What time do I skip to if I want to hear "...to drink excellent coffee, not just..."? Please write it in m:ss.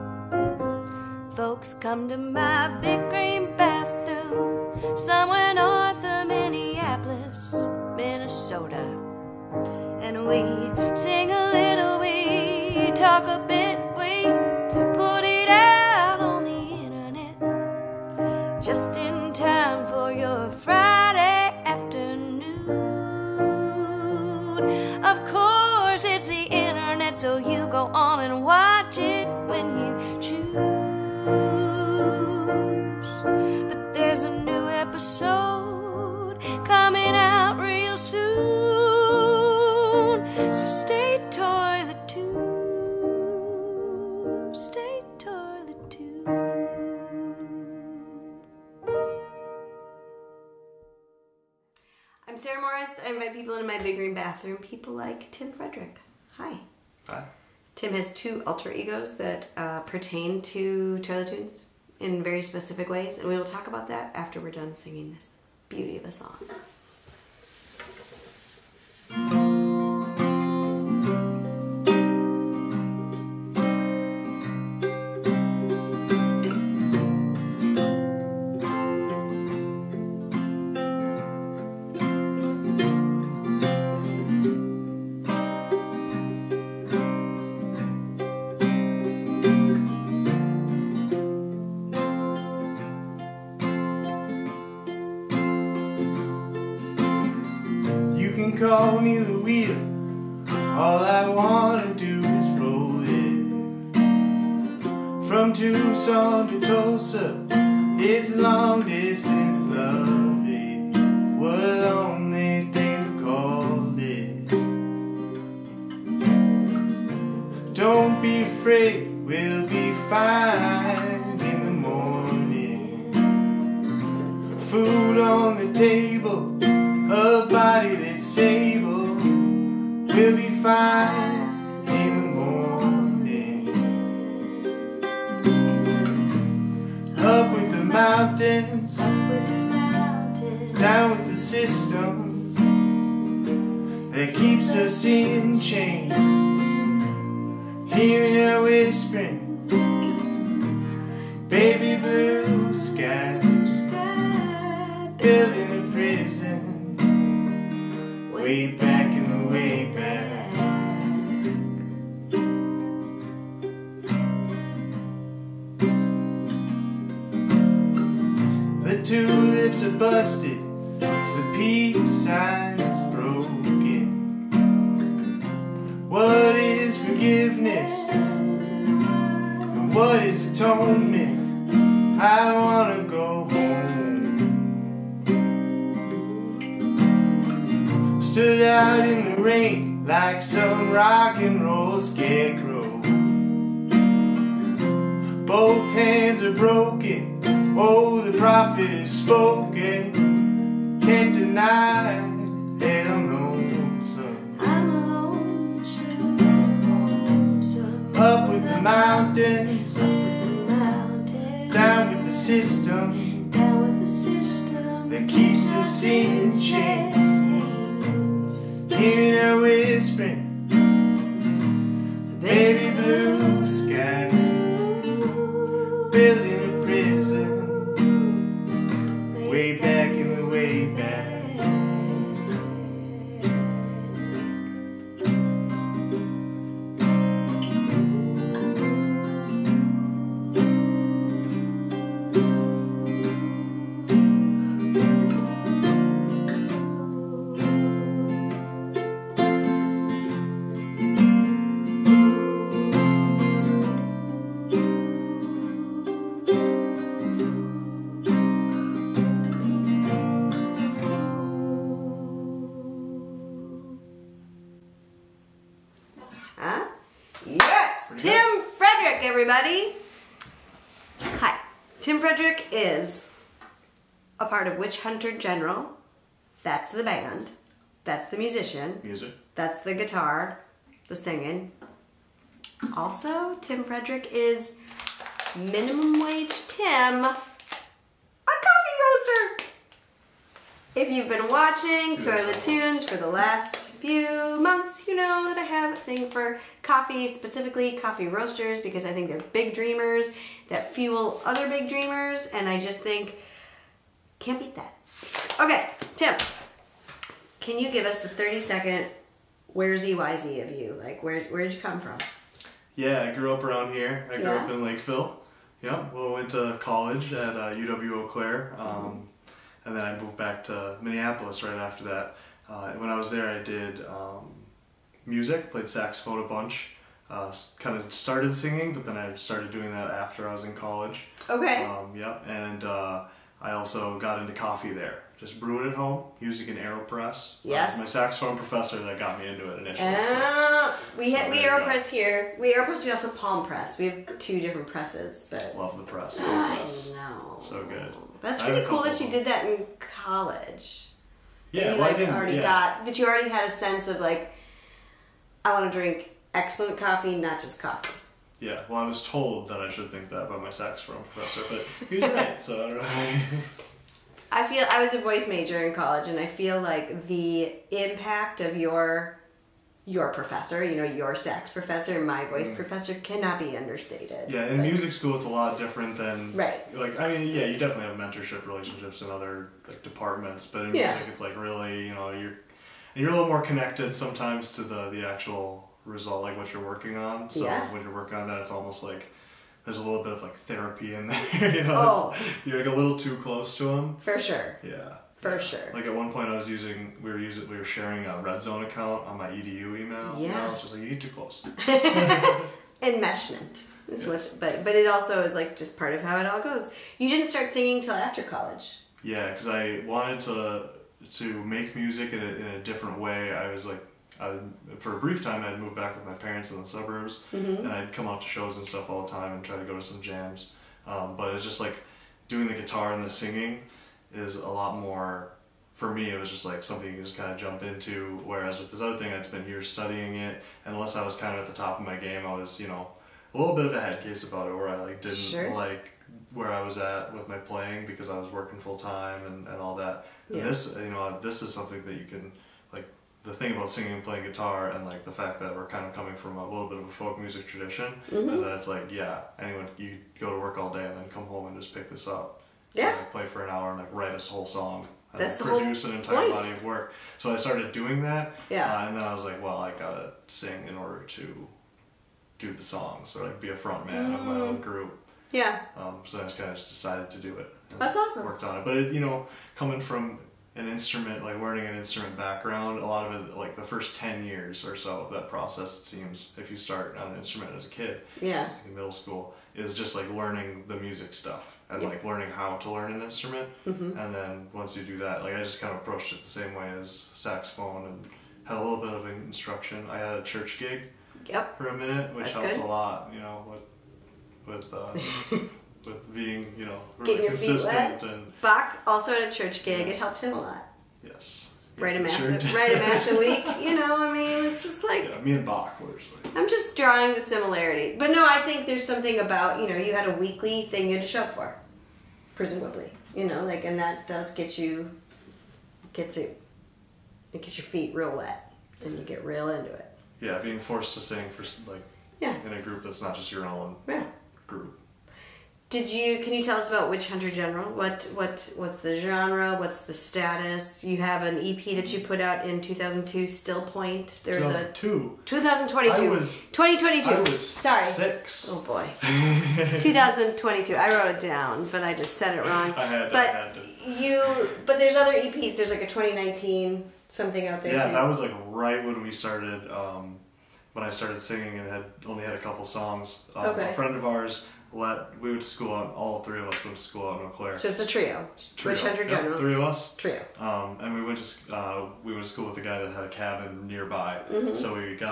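5:55.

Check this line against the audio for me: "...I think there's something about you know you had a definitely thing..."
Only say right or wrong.
wrong.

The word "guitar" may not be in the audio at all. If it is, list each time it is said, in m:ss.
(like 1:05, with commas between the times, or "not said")
4:39, 7:02, 7:24.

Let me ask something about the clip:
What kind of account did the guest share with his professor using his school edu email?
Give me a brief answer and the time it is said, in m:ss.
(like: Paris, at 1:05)
Red Zone, at 6:38.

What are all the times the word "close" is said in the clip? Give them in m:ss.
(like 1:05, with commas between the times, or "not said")
6:33, 6:41.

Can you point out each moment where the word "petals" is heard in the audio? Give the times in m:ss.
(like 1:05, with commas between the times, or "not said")
not said.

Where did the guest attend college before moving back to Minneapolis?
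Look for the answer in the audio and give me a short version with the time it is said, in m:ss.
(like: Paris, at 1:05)
UW Eau Claire, at 5:17.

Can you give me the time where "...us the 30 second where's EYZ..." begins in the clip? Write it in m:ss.
5:08.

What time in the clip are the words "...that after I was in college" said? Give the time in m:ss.
5:29.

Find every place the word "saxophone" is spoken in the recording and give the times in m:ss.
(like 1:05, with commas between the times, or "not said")
5:25, 5:38, 6:00, 8:07.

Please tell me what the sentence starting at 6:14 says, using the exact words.
Yeah, in but, music school, it's a lot different than right.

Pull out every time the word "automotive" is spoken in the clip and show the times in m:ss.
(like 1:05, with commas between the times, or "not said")
not said.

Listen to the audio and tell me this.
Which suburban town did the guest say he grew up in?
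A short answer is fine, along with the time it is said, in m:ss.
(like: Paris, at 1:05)
Lakeville, at 5:14.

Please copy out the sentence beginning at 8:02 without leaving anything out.
like learning how to learn an instrument.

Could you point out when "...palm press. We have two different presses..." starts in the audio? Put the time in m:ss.
5:43.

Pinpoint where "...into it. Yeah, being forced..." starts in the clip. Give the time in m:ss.
8:39.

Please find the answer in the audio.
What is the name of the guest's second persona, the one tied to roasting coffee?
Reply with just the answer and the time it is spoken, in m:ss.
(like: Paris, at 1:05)
Minimum Wage Tim, at 4:45.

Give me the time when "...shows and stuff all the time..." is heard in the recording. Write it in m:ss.
6:58.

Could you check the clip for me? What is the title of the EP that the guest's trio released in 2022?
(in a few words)
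Still Point.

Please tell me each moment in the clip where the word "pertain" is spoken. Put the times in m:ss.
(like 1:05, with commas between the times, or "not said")
0:59.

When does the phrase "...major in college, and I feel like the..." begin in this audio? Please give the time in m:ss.
6:05.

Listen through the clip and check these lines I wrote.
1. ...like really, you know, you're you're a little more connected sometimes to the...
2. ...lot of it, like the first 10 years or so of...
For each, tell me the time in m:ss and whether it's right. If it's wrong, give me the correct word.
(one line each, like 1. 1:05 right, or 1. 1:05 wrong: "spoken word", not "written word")
1. 6:21 right
2. 7:53 right.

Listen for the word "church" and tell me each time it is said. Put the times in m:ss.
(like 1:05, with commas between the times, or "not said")
8:10, 8:19.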